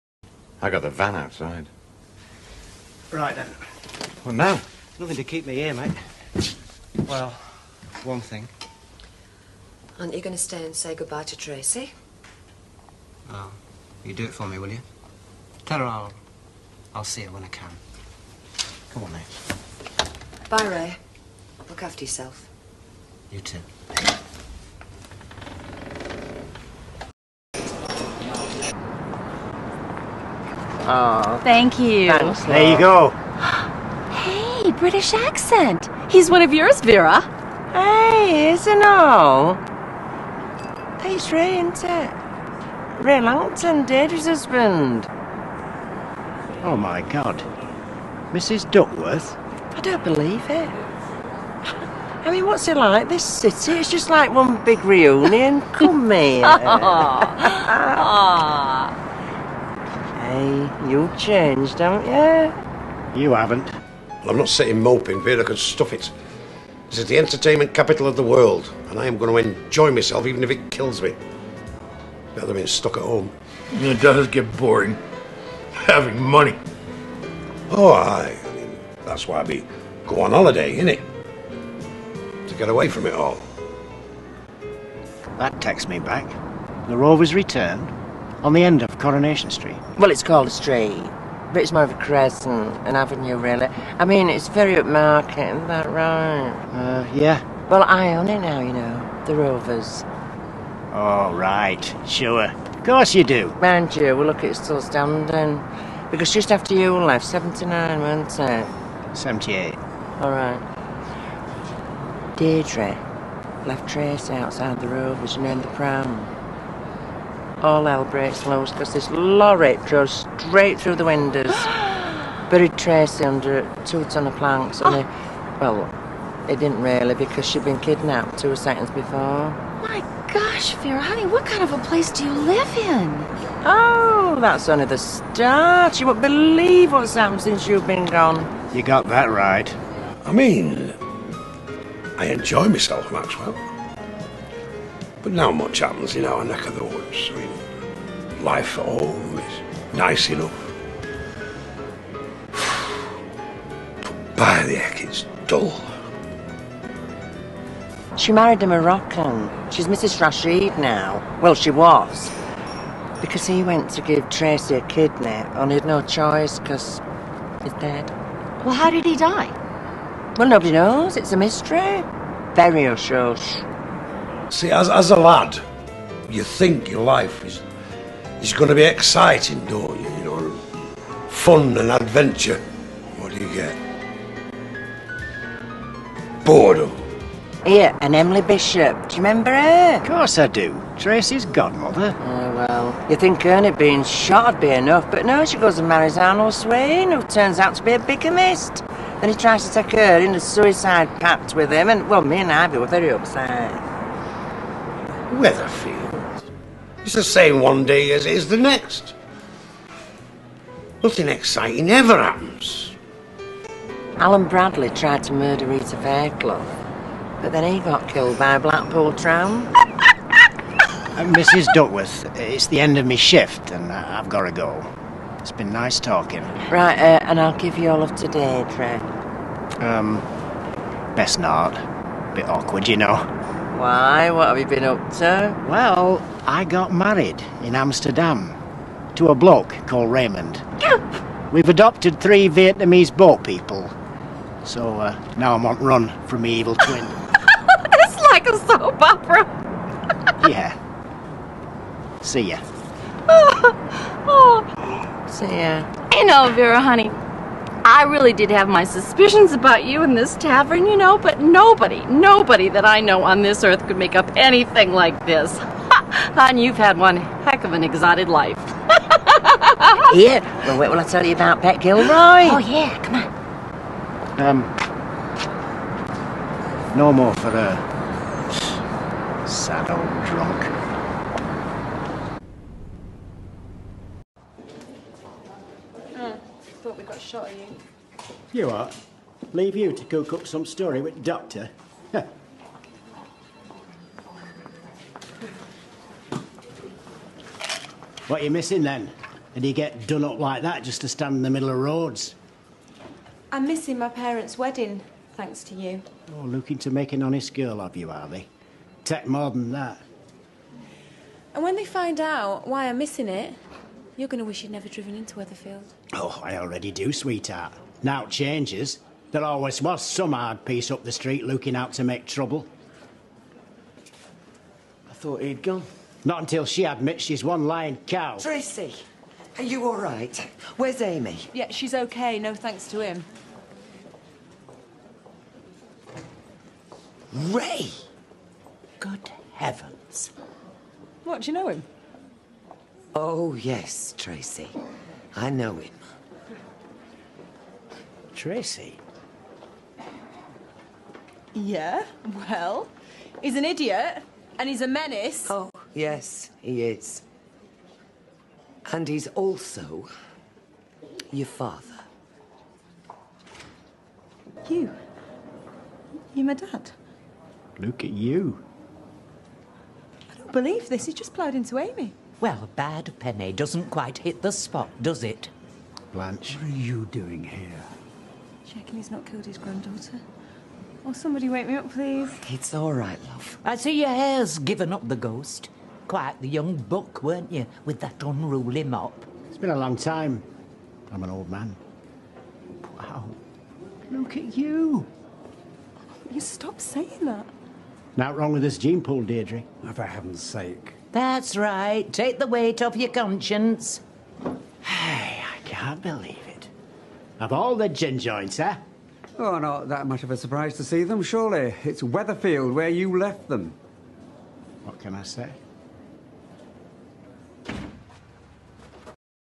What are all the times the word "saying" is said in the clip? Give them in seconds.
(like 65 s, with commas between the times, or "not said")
396 s.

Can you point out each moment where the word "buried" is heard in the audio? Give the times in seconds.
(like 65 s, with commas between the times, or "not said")
122 s.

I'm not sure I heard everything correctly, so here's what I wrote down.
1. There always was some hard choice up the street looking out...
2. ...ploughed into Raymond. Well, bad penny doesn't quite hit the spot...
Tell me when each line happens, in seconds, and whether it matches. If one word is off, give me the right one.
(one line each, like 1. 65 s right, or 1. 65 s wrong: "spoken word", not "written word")
1. 319 s wrong: "piece", not "choice"
2. 371 s wrong: "Amy", not "Raymond".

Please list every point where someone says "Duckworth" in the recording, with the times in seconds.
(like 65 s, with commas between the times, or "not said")
48 s, 221 s.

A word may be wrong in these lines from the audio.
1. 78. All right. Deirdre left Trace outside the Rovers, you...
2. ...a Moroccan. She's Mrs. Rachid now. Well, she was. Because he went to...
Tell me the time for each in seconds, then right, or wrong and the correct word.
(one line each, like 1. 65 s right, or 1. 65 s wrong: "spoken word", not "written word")
1. 109 s right
2. 158 s right.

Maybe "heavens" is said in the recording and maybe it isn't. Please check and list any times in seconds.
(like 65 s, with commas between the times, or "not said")
339 s, 400 s.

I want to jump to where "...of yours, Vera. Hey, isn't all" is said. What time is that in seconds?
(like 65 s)
36 s.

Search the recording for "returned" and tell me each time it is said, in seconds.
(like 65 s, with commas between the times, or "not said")
87 s.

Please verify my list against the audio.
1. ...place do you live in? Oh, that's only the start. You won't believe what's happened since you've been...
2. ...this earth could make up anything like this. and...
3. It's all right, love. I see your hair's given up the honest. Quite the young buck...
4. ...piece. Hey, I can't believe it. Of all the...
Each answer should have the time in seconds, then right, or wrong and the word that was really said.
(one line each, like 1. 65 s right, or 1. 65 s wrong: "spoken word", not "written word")
1. 131 s right
2. 263 s right
3. 382 s wrong: "ghost", not "honest"
4. 403 s wrong: "conscience", not "piece".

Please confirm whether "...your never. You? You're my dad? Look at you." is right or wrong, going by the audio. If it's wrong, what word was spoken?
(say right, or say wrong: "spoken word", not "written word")
wrong: "father", not "never".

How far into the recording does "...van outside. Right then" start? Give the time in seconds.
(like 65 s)
0 s.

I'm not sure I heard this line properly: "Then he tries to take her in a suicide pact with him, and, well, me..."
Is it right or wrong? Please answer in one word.
right.